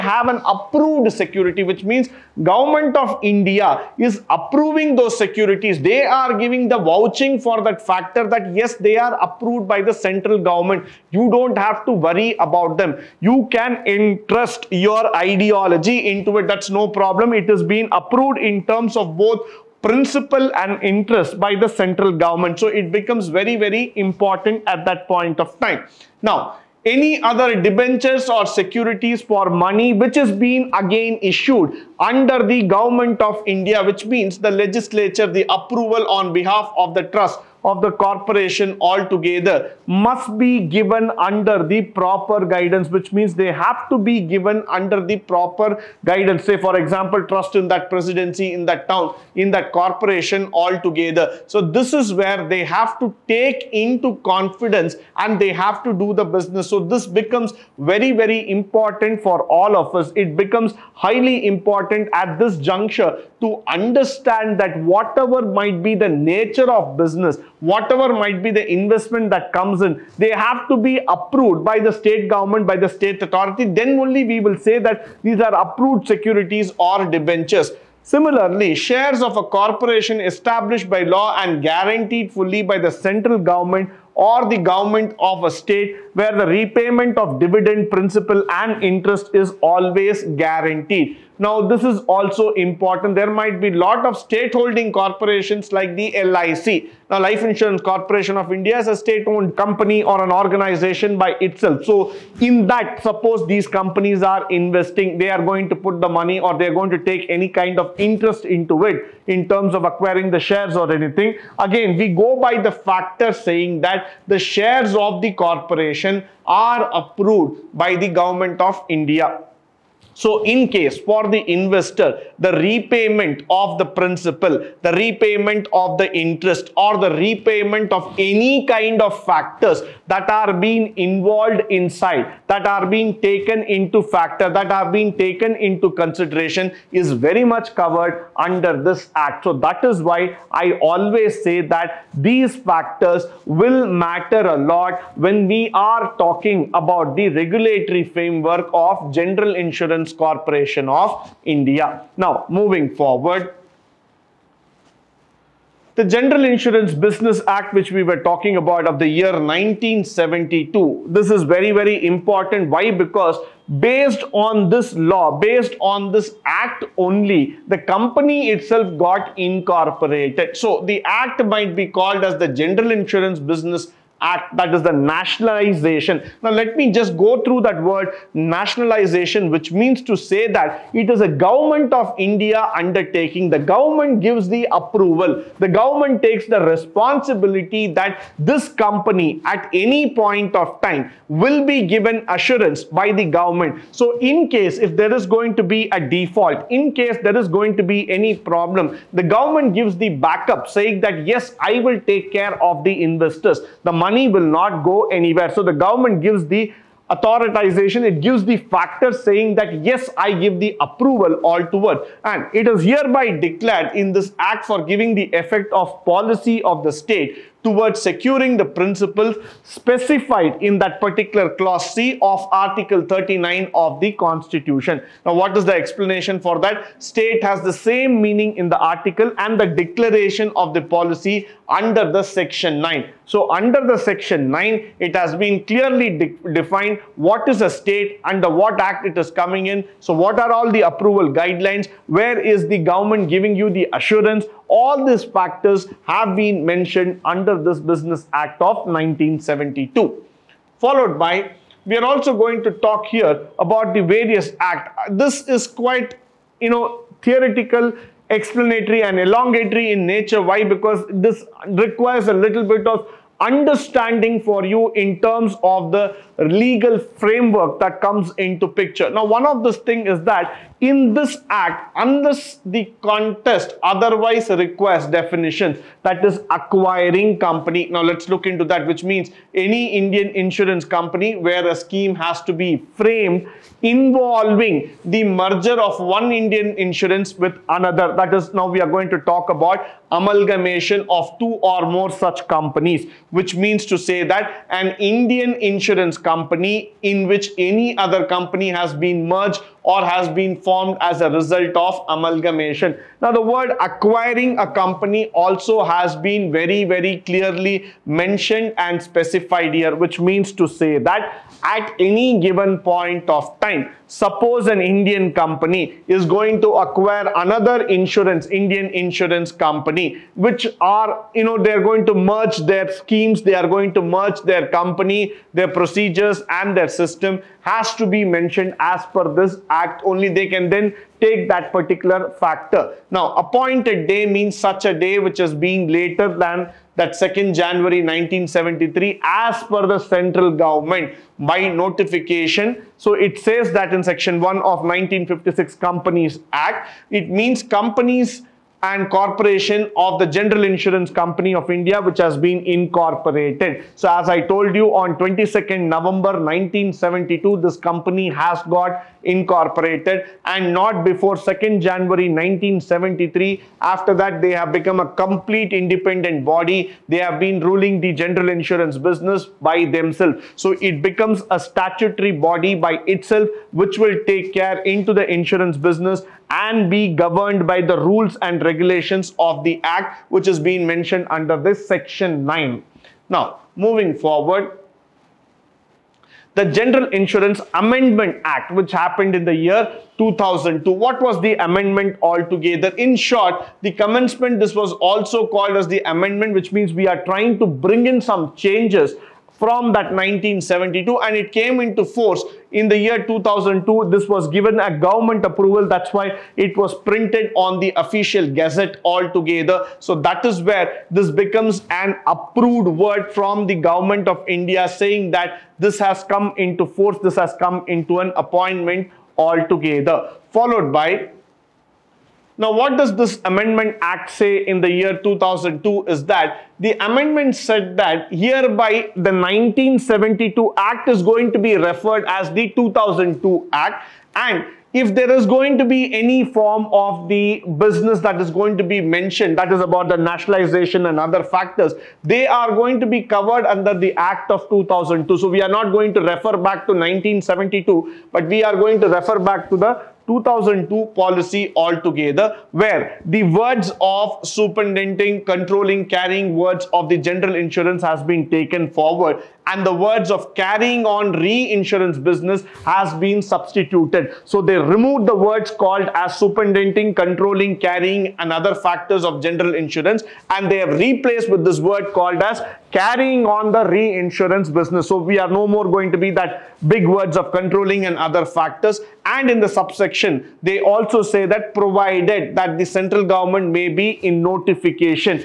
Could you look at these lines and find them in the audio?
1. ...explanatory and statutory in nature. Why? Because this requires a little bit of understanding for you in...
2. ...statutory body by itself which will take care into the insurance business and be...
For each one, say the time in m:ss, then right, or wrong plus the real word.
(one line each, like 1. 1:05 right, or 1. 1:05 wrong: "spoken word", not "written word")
1. 4:18 wrong: "elongatory", not "statutory"
2. 6:11 right.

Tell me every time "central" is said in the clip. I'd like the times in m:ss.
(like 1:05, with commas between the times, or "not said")
0:09, 0:21, 1:22, 5:39, 8:02.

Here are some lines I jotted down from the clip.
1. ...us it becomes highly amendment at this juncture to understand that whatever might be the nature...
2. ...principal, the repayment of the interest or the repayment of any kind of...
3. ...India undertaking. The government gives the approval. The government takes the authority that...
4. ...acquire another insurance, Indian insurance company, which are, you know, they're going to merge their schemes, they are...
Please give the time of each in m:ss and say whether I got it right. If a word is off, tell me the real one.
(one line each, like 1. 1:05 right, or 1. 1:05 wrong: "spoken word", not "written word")
1. 0:59 wrong: "important", not "amendment"
2. 2:03 right
3. 3:02 wrong: "responsibility", not "authority"
4. 5:16 right.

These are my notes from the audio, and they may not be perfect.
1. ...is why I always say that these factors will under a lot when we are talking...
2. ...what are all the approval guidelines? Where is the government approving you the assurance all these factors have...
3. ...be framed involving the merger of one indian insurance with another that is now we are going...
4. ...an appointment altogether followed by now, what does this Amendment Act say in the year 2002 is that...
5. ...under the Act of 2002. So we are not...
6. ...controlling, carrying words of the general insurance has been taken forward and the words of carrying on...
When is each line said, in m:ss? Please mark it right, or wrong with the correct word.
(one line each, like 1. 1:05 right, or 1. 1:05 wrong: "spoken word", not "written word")
1. 2:19 wrong: "matter", not "under"
2. 4:00 wrong: "giving", not "approving"
3. 4:42 right
4. 6:58 right
5. 7:23 right
6. 7:35 right.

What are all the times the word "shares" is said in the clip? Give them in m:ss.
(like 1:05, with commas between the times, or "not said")
1:18, 1:50, 1:54.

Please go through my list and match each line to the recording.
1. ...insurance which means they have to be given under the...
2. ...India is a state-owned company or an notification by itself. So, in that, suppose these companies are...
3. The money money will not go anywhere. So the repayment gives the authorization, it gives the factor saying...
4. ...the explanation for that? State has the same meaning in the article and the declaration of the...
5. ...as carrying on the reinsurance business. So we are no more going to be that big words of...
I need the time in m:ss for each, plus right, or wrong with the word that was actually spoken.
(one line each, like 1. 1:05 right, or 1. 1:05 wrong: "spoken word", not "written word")
1. 0:42 wrong: "guidance", not "insurance"
2. 1:38 wrong: "organization", not "notification"
3. 3:23 wrong: "government", not "repayment"
4. 3:45 right
5. 7:52 right.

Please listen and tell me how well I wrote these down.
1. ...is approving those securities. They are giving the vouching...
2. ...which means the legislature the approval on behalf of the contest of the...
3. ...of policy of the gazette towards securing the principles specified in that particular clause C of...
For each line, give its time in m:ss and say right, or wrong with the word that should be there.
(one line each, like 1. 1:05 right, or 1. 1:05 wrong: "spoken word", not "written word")
1. 0:03 right
2. 0:33 wrong: "trust", not "contest"
3. 3:35 wrong: "state", not "gazette".